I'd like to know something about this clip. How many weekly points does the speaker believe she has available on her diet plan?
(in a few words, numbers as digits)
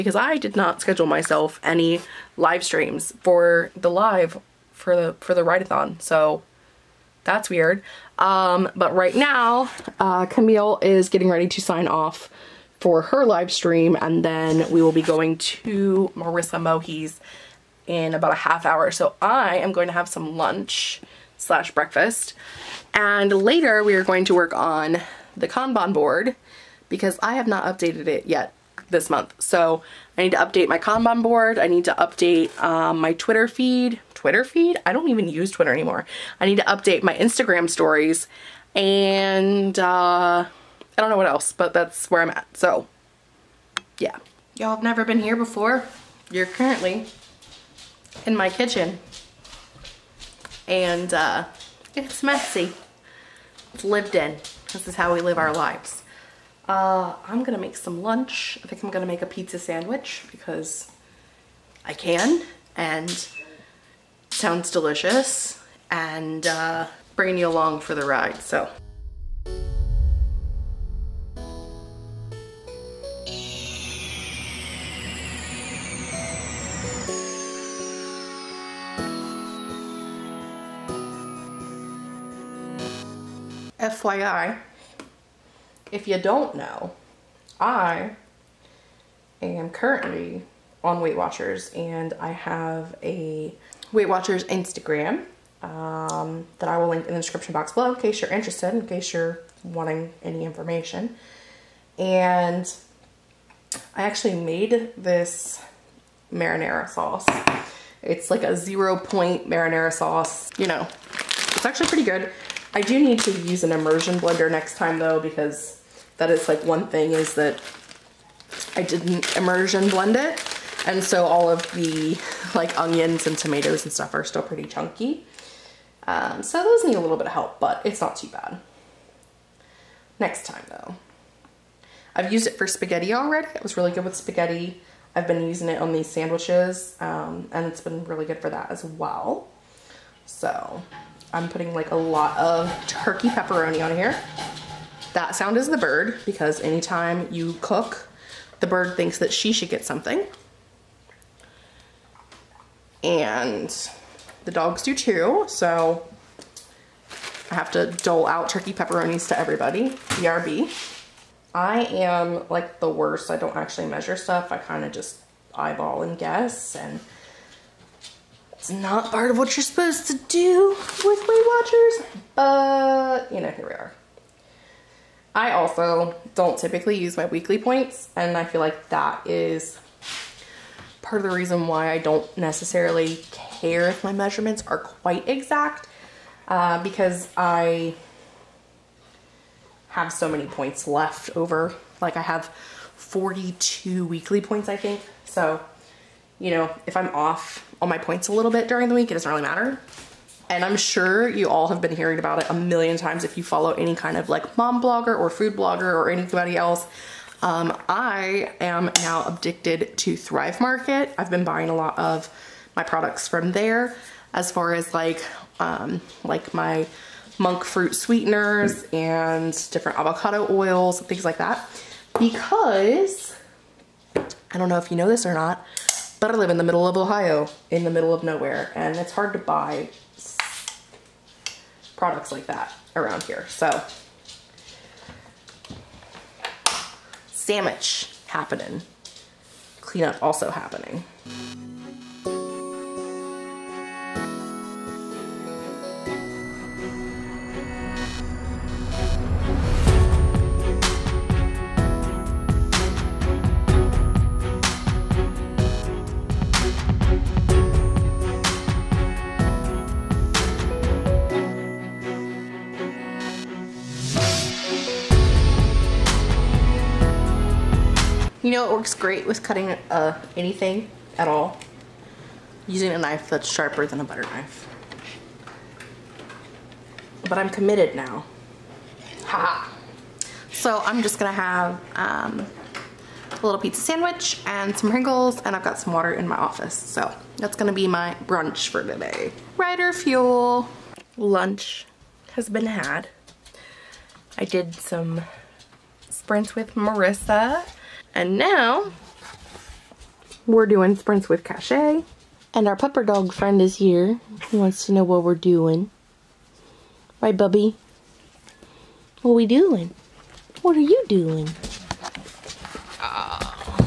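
42.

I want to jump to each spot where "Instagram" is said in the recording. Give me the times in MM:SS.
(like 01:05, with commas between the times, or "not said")
00:37, 01:34.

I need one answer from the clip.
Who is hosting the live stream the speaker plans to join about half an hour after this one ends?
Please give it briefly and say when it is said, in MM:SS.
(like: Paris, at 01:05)
Marissa Mohi, at 00:16.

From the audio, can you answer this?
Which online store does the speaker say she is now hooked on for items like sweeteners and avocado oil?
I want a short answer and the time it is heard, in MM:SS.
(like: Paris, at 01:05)
Thrive Market, at 03:30.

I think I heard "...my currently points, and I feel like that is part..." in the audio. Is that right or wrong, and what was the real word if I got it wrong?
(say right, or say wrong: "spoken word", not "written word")
wrong: "weekly", not "currently".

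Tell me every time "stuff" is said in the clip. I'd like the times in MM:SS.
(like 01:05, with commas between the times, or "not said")
02:03, 02:44.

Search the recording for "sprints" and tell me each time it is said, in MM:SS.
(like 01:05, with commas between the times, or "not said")
04:56, 05:00.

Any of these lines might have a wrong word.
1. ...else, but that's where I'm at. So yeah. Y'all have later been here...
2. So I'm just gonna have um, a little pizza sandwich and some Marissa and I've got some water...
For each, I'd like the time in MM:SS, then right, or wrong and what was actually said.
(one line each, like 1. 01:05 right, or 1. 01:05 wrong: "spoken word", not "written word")
1. 00:41 wrong: "never", not "later"
2. 04:40 wrong: "Pringles", not "Marissa".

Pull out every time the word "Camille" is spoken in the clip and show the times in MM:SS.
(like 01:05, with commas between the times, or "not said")
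00:10.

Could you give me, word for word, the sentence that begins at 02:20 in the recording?
So I'm putting like a lot of turkey pepperoni on here.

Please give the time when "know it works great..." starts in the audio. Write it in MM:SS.
04:28.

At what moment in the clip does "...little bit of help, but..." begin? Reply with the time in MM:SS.
02:07.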